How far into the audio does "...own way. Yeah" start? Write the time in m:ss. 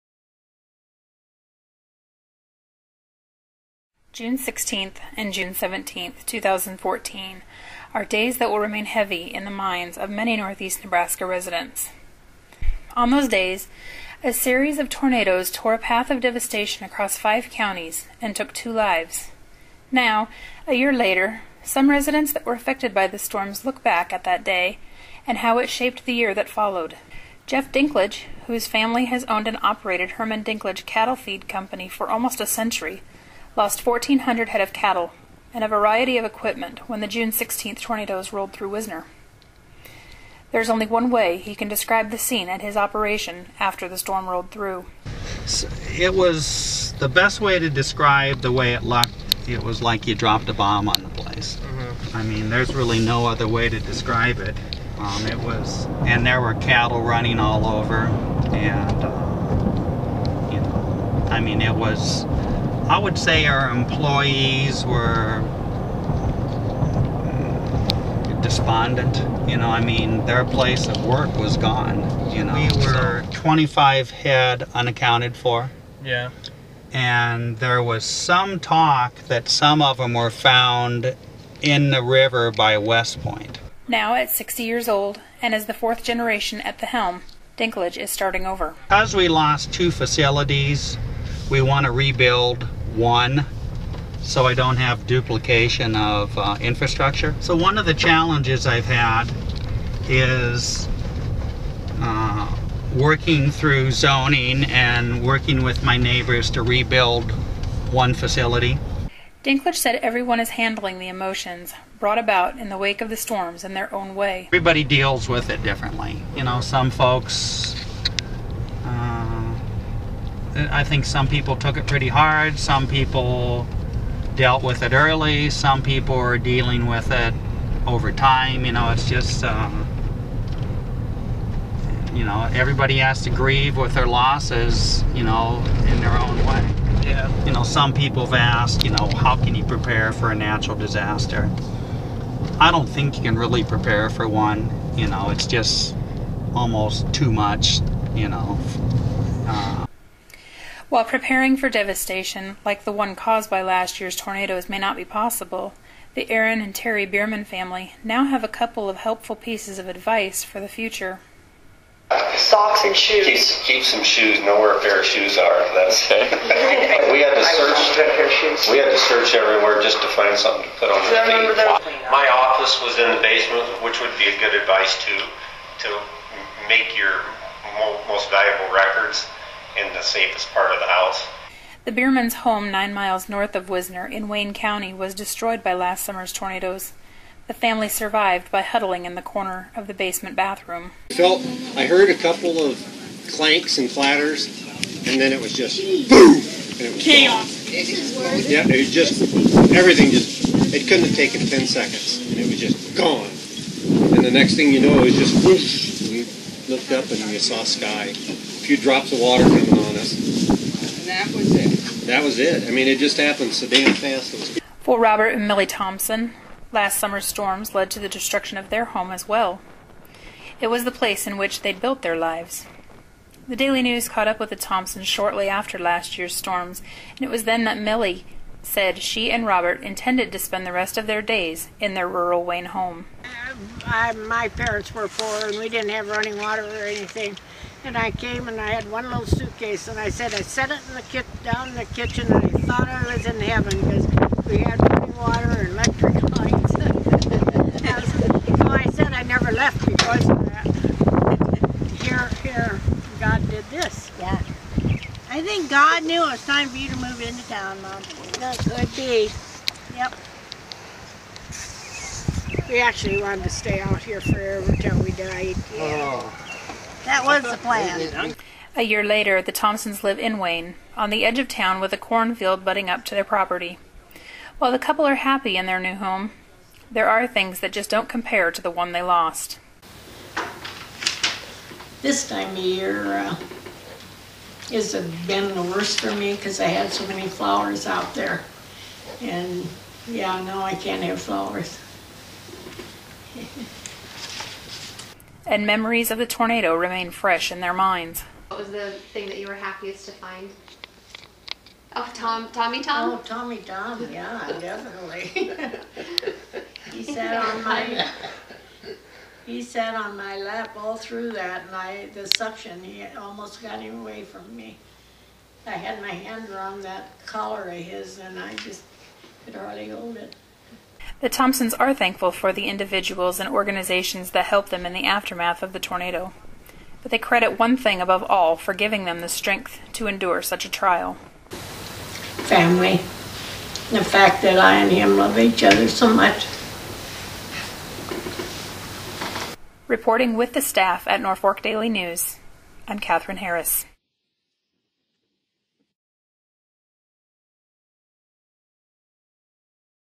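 2:16.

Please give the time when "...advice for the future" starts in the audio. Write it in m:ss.
2:39.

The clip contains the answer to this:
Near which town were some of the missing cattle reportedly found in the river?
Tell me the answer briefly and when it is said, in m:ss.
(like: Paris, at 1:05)
West Point, at 1:22.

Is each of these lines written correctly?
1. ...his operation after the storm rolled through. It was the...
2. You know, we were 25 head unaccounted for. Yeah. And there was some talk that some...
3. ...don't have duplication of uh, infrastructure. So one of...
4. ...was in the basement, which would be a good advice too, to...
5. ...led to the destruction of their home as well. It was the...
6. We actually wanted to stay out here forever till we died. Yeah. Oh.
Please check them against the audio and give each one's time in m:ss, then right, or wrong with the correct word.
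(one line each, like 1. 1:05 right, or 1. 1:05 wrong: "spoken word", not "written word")
1. 0:42 right
2. 1:12 right
3. 1:34 right
4. 2:52 right
5. 3:37 right
6. 4:22 right.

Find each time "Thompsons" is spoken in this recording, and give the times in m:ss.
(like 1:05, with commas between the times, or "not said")
3:35, 3:44, 4:29, 5:21.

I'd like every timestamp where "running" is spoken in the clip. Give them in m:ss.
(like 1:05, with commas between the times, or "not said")
0:57, 3:56, 4:04.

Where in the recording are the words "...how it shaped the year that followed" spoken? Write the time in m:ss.
0:25.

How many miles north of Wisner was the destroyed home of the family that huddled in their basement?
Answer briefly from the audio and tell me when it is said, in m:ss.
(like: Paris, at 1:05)
9, at 3:02.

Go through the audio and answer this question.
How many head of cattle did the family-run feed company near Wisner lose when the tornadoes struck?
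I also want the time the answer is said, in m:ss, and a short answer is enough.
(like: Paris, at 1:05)
1,400, at 0:33.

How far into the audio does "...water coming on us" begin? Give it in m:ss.
3:29.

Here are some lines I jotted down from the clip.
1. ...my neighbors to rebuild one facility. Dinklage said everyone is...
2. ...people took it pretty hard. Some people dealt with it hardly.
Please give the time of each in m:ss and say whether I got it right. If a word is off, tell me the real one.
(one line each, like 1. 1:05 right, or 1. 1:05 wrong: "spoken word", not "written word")
1. 1:45 right
2. 2:01 wrong: "early", not "hardly".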